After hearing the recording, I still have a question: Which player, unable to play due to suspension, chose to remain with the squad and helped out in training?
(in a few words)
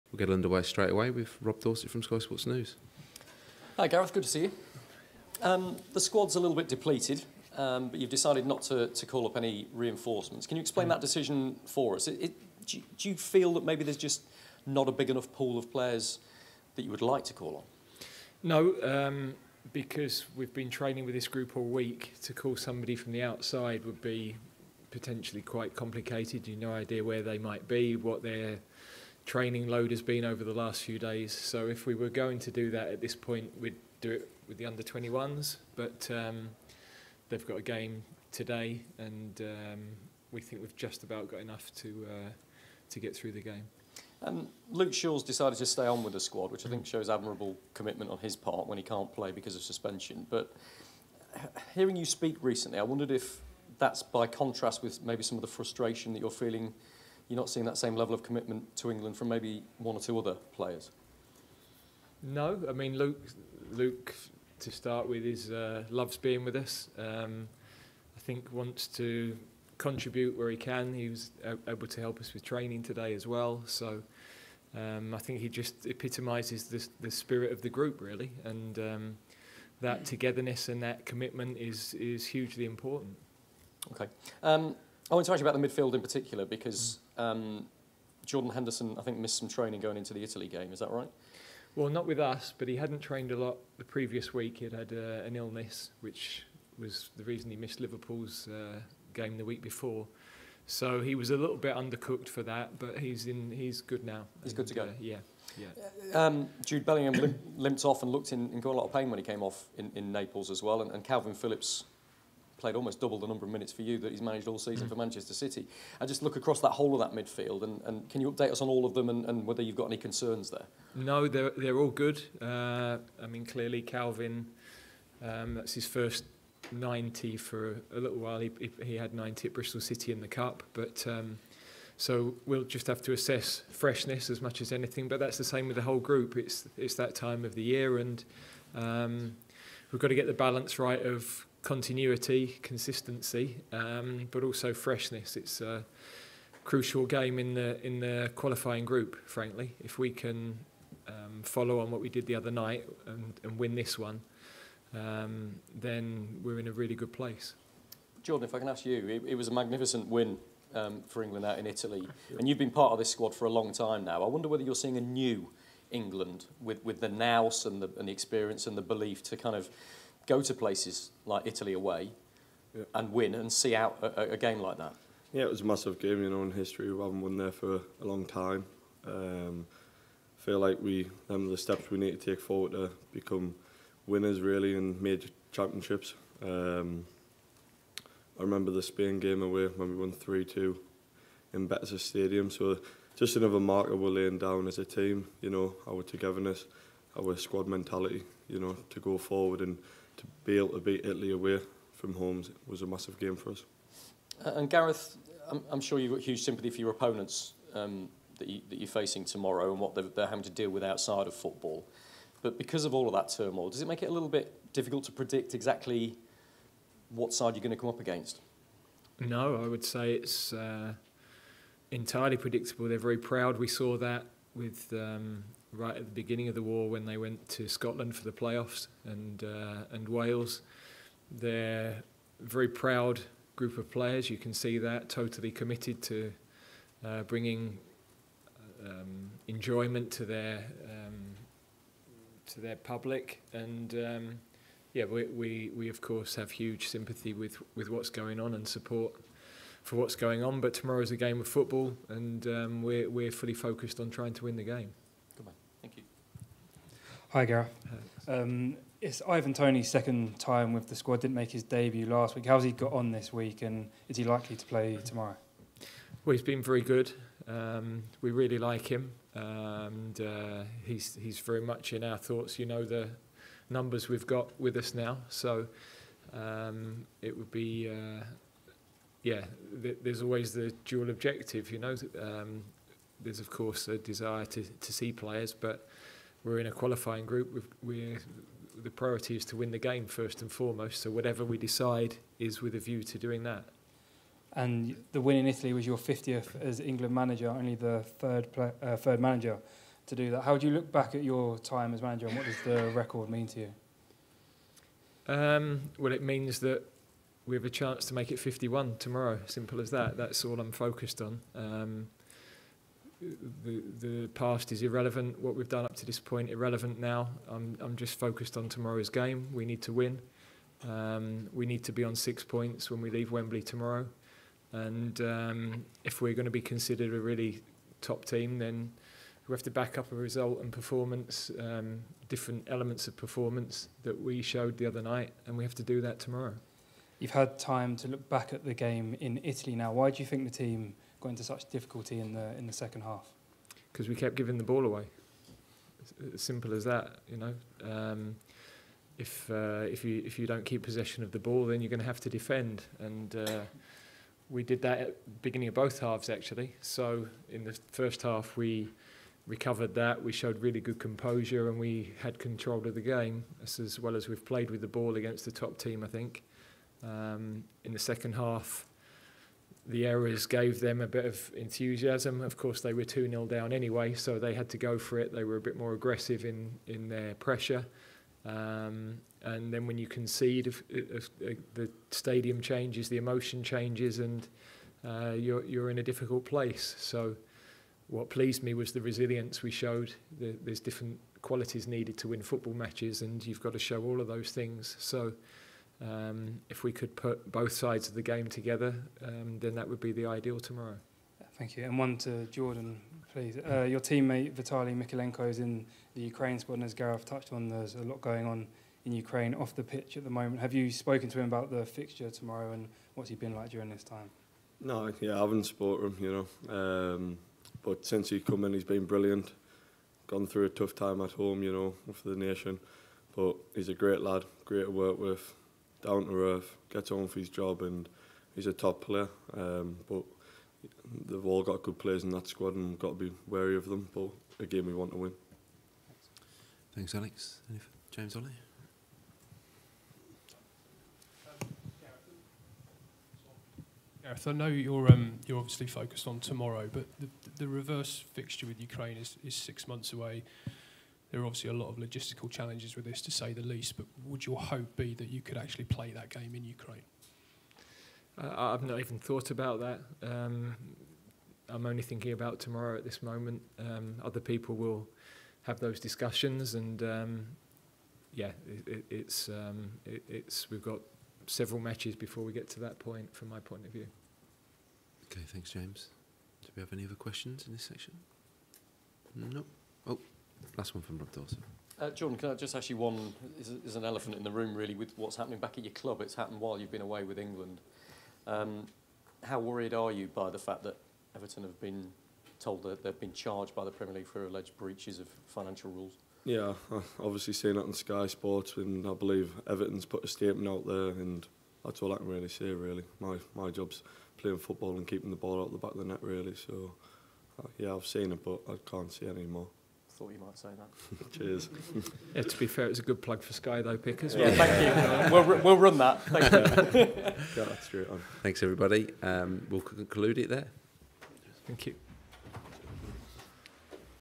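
Luke Shaw.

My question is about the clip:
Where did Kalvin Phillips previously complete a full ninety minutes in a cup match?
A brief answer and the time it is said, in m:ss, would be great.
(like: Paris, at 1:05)
Bristol City, at 2:09.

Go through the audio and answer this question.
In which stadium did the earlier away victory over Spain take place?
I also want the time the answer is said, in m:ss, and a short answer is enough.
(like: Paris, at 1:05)
Betis Stadium, at 3:11.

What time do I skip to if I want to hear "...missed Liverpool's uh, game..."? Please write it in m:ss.
1:37.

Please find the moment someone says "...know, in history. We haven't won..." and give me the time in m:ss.
2:56.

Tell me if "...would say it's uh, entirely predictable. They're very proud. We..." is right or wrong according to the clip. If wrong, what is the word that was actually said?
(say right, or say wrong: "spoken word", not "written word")
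right.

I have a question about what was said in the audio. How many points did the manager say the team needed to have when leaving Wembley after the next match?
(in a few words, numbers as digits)
6.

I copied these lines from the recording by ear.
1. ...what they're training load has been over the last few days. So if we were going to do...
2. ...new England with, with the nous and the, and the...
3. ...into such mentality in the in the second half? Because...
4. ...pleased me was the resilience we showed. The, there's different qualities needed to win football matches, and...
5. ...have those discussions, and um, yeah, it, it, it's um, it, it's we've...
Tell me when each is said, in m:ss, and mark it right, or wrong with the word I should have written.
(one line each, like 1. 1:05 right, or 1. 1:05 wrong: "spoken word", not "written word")
1. 0:27 right
2. 2:45 right
3. 5:41 wrong: "difficulty", not "mentality"
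4. 6:28 right
5. 7:45 right.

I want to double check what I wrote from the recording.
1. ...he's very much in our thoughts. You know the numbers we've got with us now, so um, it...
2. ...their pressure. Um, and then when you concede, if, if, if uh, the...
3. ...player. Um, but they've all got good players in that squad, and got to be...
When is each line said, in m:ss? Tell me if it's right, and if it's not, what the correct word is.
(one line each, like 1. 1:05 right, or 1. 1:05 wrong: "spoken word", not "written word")
1. 4:31 right
2. 6:17 right
3. 7:09 right.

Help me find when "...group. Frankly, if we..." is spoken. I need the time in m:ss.
2:28.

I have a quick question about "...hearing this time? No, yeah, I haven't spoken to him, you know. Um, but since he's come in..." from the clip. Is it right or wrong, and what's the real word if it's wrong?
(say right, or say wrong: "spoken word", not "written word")
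wrong: "during", not "hearing".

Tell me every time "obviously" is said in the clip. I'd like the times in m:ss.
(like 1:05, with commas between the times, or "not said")
7:25, 7:31, 8:17.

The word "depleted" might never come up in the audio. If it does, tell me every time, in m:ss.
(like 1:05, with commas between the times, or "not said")
0:06.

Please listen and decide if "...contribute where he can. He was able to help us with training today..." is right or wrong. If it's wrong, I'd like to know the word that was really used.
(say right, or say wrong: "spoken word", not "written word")
right.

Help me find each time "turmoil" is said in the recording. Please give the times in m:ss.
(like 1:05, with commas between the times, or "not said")
3:33.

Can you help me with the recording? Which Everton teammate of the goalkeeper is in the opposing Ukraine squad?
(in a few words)
Vitaly Mykolenko.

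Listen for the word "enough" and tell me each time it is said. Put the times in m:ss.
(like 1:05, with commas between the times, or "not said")
0:15, 0:41.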